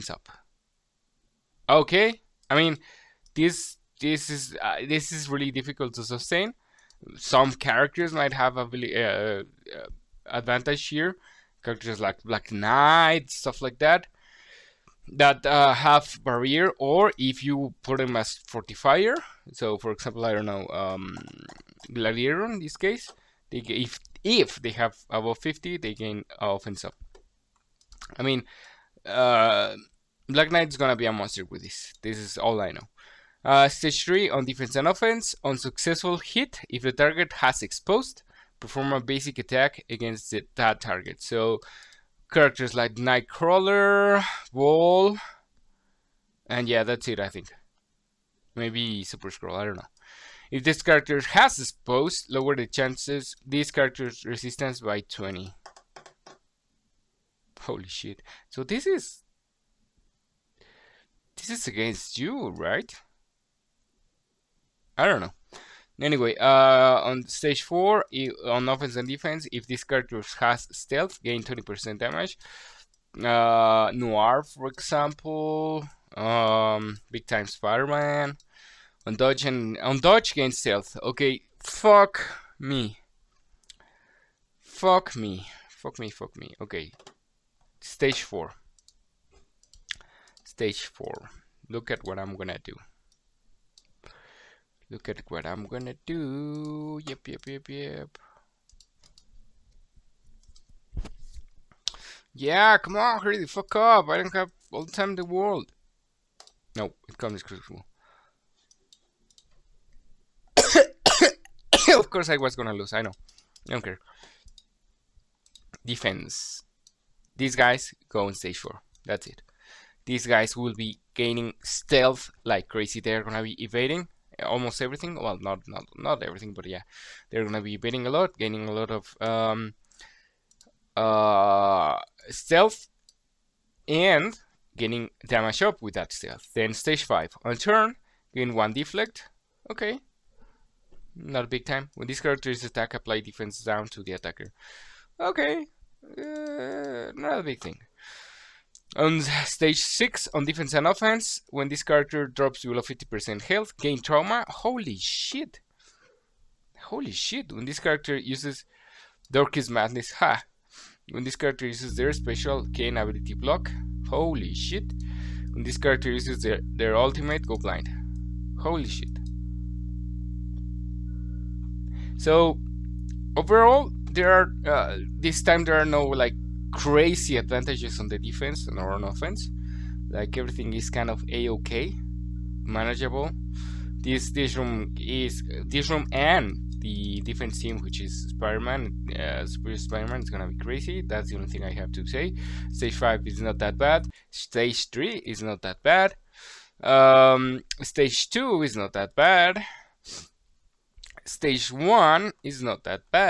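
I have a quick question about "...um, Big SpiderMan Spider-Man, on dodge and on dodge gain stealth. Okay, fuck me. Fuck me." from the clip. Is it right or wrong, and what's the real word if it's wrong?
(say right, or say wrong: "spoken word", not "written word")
wrong: "Time", not "SpiderMan".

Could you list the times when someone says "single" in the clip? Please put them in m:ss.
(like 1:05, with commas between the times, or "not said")
not said.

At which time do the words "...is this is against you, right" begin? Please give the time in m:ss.
0:58.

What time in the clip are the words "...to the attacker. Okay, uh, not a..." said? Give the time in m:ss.
2:23.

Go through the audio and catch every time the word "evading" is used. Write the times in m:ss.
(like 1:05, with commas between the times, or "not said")
2:03, 2:07.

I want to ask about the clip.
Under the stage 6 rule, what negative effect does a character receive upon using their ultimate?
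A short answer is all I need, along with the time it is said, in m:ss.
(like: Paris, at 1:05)
blind, at 2:47.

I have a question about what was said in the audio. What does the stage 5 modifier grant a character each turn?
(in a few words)
one deflect.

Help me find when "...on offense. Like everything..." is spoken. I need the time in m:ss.
2:58.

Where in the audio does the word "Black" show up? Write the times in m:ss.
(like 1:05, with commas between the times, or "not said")
0:12, 0:30.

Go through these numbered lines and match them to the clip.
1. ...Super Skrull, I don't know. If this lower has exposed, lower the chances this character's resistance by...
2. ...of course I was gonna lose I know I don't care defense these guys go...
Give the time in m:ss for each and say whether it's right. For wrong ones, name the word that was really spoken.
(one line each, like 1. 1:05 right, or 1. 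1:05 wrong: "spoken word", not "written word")
1. 0:49 wrong: "character", not "lower"
2. 1:51 right.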